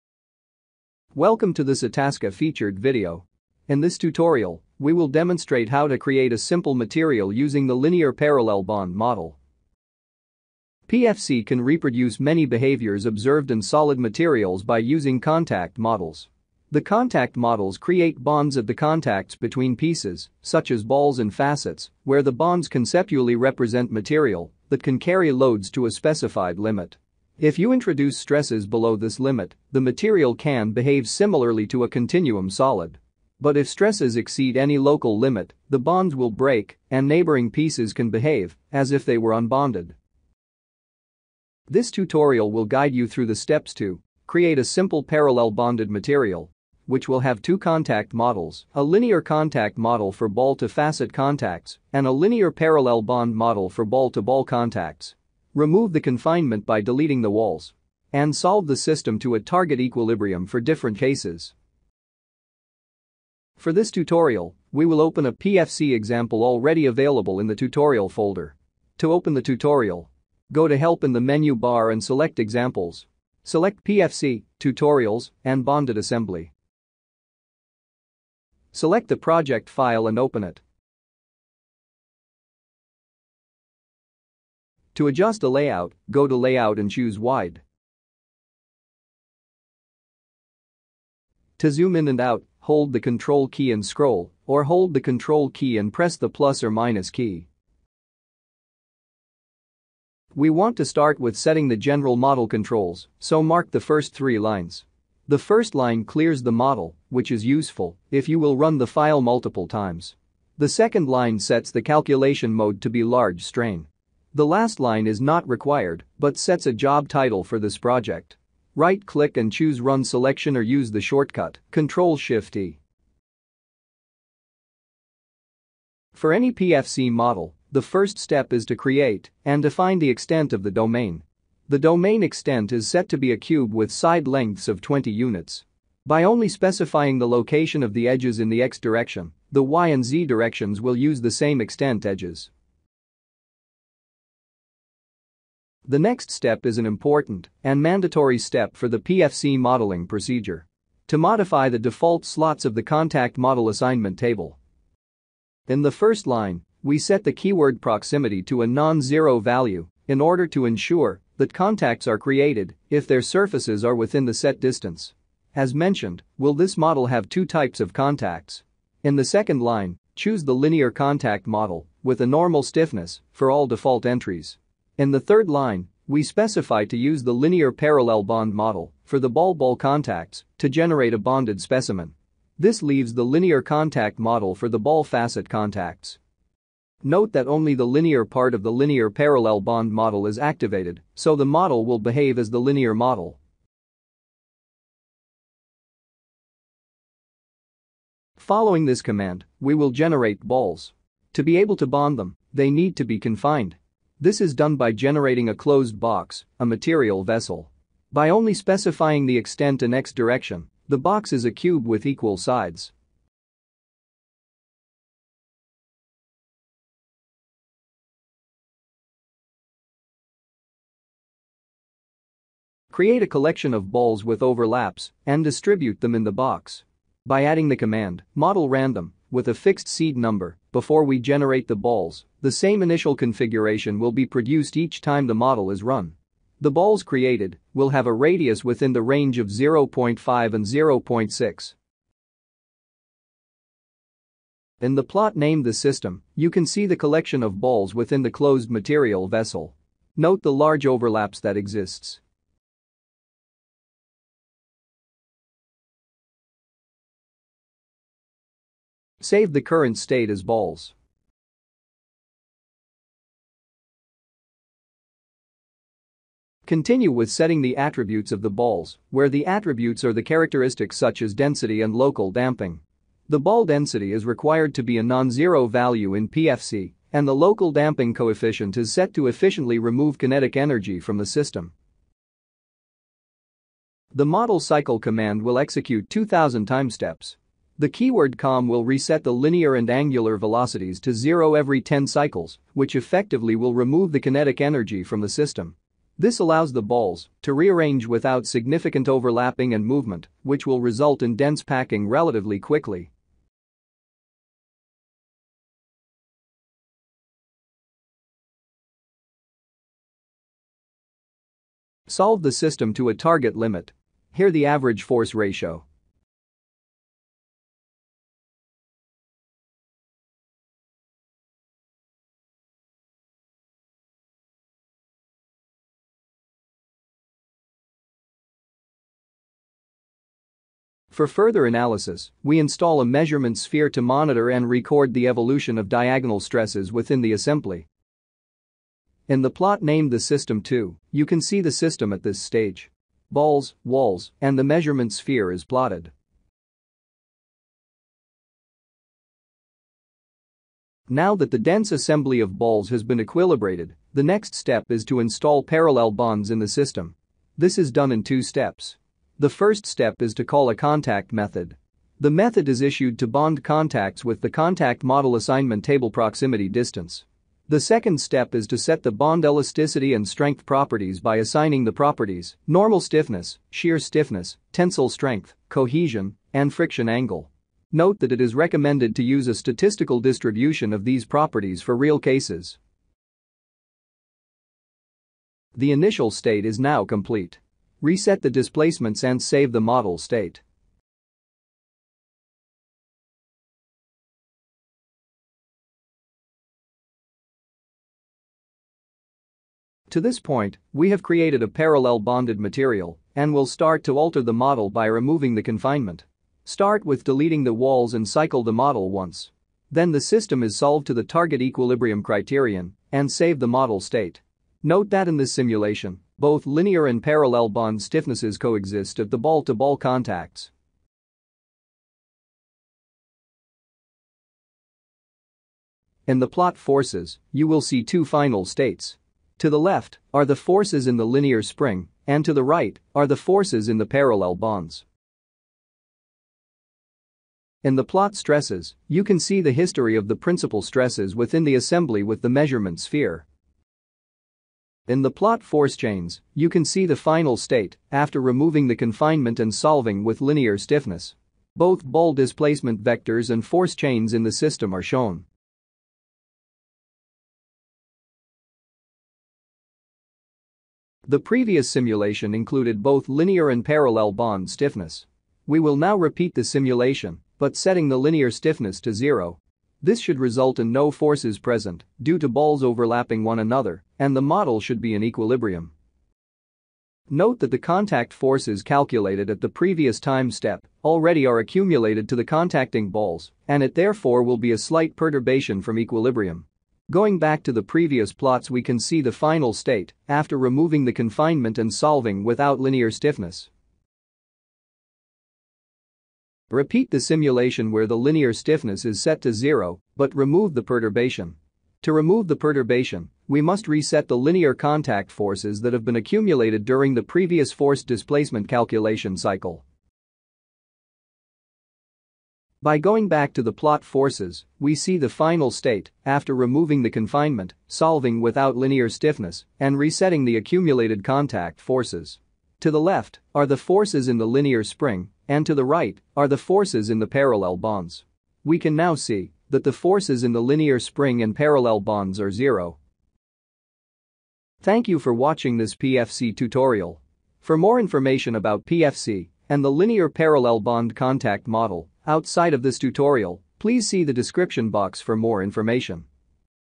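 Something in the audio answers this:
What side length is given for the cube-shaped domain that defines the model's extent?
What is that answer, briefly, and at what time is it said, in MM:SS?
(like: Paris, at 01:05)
20 units, at 02:14.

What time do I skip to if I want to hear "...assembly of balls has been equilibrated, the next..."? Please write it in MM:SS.
05:51.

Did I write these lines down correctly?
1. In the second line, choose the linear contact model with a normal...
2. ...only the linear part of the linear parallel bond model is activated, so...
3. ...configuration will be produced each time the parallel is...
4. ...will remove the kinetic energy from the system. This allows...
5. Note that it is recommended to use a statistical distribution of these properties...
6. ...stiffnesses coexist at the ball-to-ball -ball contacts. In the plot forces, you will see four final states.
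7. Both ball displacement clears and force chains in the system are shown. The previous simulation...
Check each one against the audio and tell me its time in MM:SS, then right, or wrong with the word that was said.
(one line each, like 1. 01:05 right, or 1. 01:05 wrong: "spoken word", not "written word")
1. 02:49 right
2. 03:07 right
3. 03:53 wrong: "model", not "parallel"
4. 04:53 right
5. 06:17 right
6. 06:57 wrong: "two", not "four"
7. 07:31 wrong: "vectors", not "clears".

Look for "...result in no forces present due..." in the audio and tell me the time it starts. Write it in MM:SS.
07:50.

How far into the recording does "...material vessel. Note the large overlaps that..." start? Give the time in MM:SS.
04:08.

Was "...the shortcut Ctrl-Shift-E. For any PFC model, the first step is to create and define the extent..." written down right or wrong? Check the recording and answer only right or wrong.
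right.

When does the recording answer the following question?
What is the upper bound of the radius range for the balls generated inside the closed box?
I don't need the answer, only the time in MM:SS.
04:00.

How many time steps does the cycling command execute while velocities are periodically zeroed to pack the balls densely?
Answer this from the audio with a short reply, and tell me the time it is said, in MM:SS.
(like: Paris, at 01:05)
2000, at 04:46.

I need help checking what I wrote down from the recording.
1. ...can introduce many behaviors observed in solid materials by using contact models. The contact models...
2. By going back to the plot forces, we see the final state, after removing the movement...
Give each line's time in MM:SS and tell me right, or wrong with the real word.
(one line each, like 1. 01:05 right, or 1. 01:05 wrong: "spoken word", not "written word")
1. 00:11 wrong: "reproduce", not "introduce"
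2. 08:32 wrong: "confinement", not "movement".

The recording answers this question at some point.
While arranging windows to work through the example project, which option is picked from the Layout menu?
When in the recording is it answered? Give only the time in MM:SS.
01:27.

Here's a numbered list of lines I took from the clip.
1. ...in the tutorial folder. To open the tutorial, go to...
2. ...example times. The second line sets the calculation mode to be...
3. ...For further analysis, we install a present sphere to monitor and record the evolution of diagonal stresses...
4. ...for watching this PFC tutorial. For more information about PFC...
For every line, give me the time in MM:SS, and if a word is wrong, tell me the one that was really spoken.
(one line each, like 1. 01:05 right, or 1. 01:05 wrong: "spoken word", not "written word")
1. 01:07 right
2. 01:49 wrong: "multiple", not "example"
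3. 05:31 wrong: "measurement", not "present"
4. 08:55 right.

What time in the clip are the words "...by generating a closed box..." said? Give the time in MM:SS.
03:24.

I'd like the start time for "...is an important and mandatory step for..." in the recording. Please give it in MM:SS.
02:26.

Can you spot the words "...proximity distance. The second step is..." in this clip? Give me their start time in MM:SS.
06:06.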